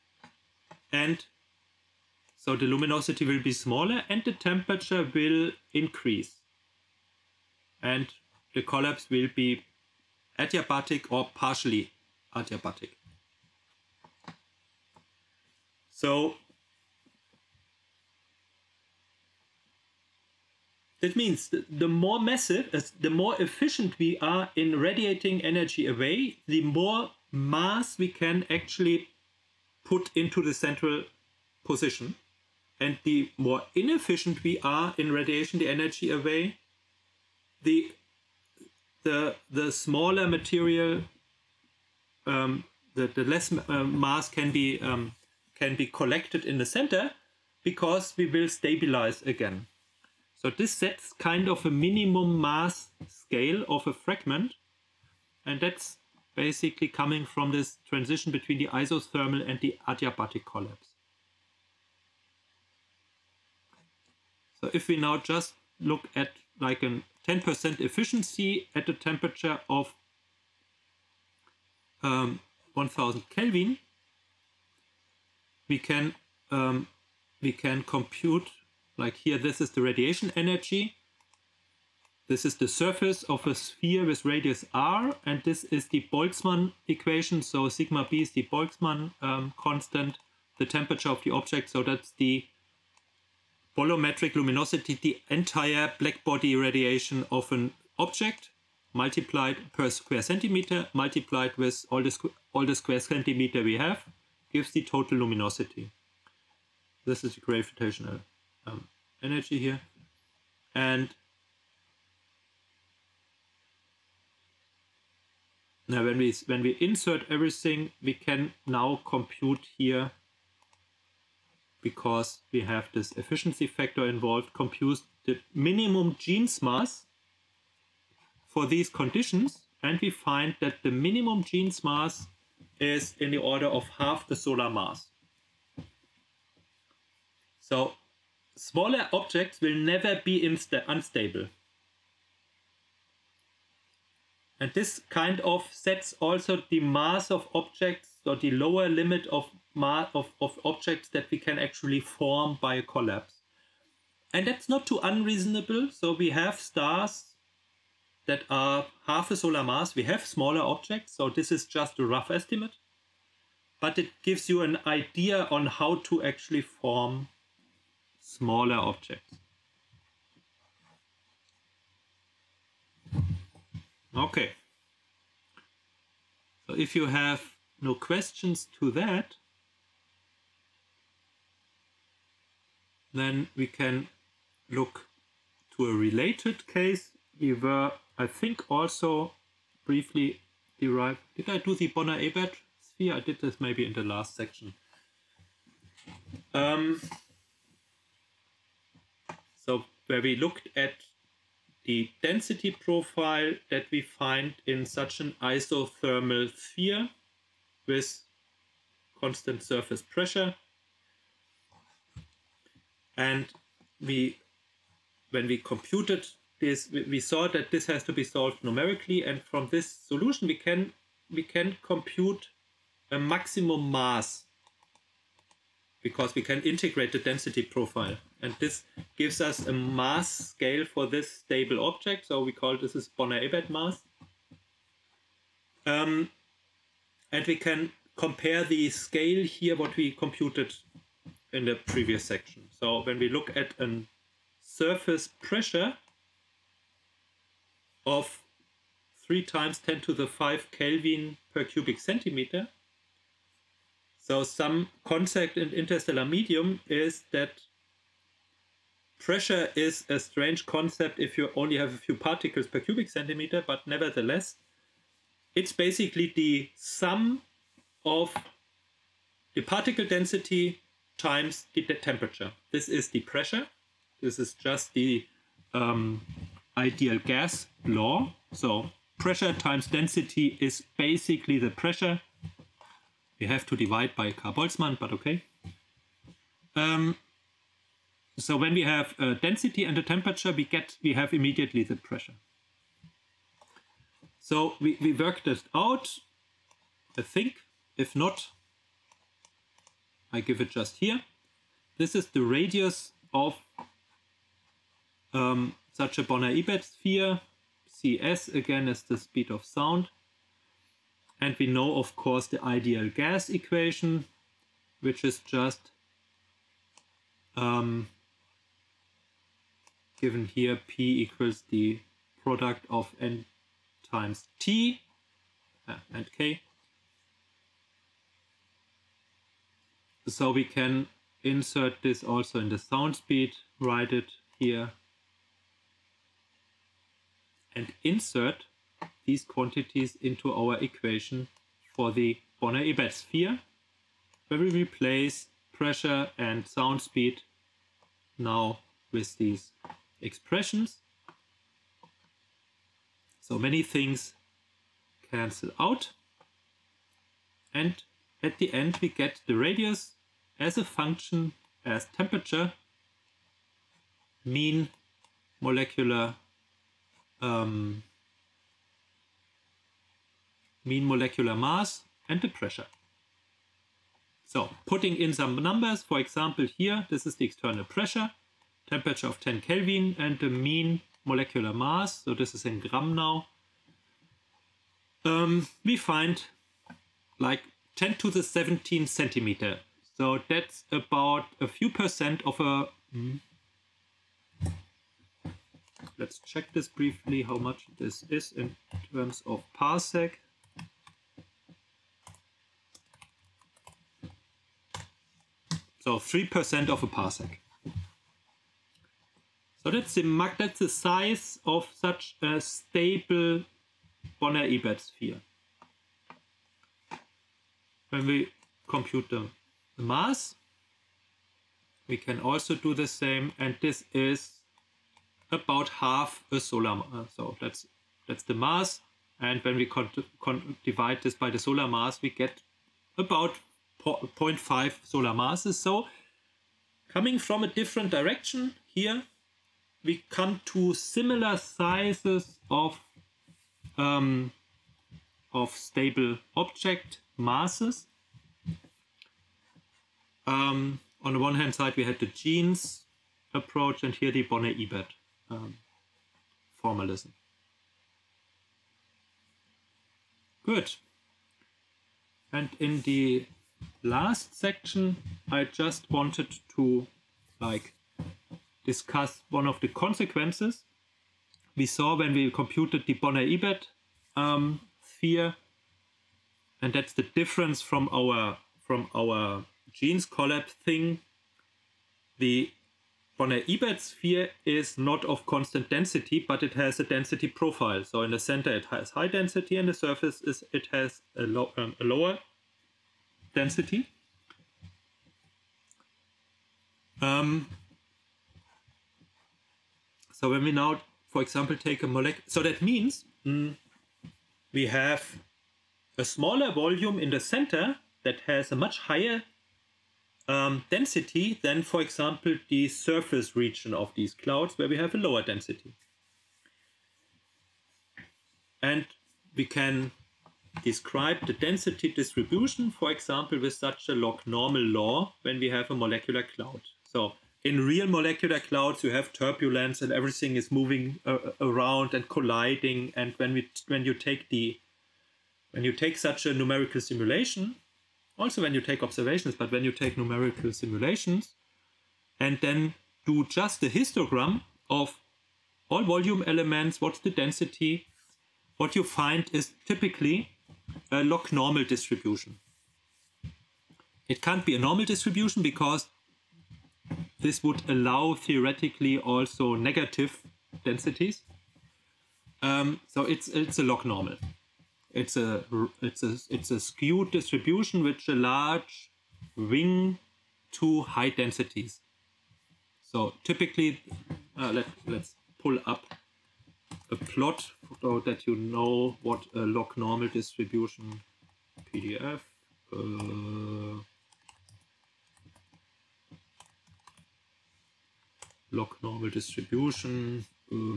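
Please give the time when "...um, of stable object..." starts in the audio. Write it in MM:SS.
07:23.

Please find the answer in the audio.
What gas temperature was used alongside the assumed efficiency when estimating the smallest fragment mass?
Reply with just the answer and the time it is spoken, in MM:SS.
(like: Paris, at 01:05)
1000 Kelvin, at 01:12.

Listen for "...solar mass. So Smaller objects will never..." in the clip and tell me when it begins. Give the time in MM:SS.
02:14.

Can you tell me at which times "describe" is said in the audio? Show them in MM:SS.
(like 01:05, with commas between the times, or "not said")
08:40.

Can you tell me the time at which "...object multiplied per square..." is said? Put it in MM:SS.
01:37.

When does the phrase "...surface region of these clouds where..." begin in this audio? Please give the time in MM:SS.
08:32.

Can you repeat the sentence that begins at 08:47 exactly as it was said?
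So in real molecular clouds, you have turbulence and everything is moving uh, uh, around and colliding.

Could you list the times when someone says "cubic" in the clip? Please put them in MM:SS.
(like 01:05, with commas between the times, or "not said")
04:11, 04:22.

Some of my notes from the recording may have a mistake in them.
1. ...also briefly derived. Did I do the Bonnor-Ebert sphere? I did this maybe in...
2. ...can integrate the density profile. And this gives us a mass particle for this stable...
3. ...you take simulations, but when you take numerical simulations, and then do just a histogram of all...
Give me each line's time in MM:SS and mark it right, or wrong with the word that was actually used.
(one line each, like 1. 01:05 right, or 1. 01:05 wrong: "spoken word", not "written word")
1. 03:08 right
2. 03:46 wrong: "scale", not "particle"
3. 08:58 wrong: "observations", not "simulations".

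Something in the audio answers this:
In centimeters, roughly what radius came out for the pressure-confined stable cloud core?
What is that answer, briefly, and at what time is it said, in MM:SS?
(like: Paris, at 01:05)
10^17 centimeters, at 06:27.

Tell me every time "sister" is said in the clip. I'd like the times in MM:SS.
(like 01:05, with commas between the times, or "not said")
not said.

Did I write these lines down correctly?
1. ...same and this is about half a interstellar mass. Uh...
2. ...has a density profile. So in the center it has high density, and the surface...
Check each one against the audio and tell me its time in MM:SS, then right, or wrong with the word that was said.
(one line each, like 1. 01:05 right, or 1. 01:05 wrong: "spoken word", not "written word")
1. 07:03 wrong: "solar", not "interstellar"
2. 08:06 right.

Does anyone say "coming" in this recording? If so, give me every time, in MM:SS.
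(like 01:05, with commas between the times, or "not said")
00:56, 07:17.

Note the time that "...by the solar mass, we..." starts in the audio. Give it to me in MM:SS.
07:11.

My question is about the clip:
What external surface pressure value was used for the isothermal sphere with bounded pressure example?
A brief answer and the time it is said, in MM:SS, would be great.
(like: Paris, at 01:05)
3 times 10 to the 5, at 04:09.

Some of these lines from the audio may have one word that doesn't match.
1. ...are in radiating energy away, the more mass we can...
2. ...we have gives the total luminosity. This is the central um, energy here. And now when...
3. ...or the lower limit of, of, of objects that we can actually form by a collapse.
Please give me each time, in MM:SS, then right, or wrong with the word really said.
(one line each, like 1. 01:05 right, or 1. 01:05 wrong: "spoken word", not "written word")
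1. 00:24 right
2. 01:43 wrong: "gravitational", not "central"
3. 02:28 right.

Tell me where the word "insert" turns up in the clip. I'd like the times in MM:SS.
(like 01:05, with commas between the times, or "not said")
01:56, 05:31, 05:38.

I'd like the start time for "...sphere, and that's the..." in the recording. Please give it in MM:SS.
07:55.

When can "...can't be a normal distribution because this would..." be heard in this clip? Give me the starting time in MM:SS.
09:14.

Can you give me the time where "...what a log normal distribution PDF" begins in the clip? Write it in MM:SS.
09:39.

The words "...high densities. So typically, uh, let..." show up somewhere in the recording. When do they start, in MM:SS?
09:31.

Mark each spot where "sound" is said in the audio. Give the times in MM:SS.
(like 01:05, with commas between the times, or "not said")
05:09, 05:32, 05:46.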